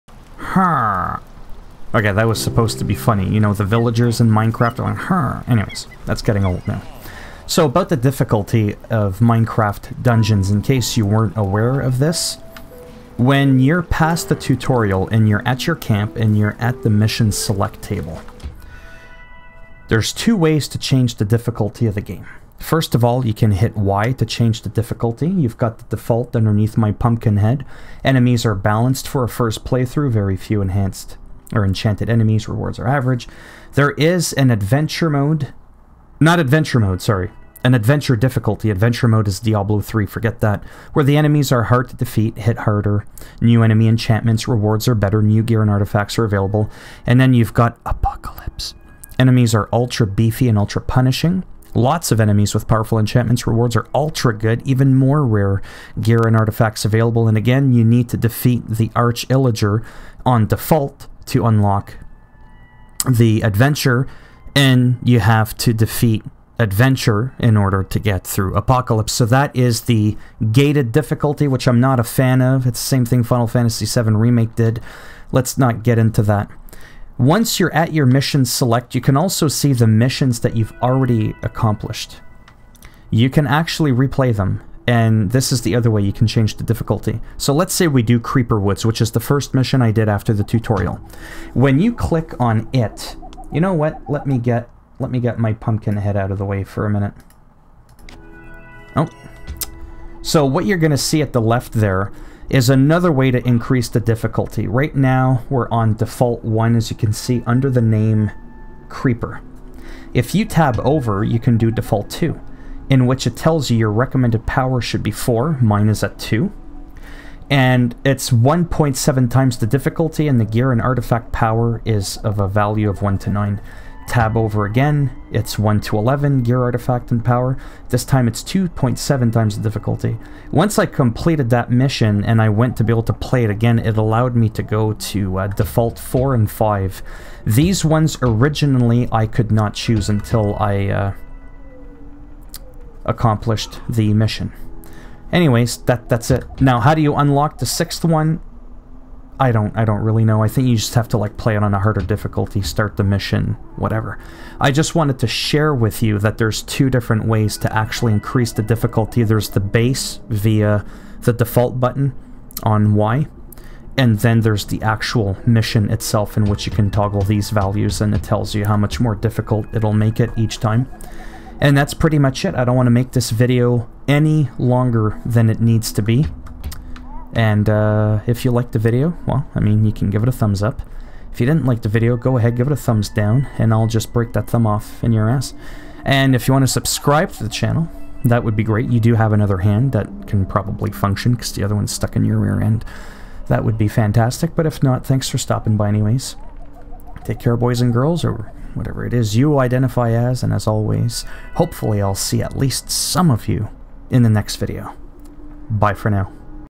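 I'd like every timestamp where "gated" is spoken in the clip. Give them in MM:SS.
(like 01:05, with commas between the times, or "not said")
01:10.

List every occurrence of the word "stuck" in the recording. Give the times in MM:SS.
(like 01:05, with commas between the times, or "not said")
03:11.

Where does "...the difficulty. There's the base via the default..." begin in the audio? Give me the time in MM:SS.
02:38.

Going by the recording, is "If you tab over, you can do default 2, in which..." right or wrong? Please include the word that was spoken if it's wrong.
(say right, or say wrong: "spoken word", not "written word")
right.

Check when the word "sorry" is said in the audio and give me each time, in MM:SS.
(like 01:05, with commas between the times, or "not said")
00:37.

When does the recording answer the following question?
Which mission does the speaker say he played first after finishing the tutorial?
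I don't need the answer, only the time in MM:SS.
01:28.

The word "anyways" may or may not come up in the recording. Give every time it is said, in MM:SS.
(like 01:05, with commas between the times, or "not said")
00:05, 02:25, 03:15.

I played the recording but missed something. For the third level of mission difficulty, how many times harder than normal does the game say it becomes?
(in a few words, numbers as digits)
2.7 times.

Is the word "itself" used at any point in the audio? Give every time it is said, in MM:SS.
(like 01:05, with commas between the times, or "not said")
02:45.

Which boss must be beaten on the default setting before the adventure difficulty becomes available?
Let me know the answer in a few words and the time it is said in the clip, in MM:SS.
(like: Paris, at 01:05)
Arch Illager, at 00:58.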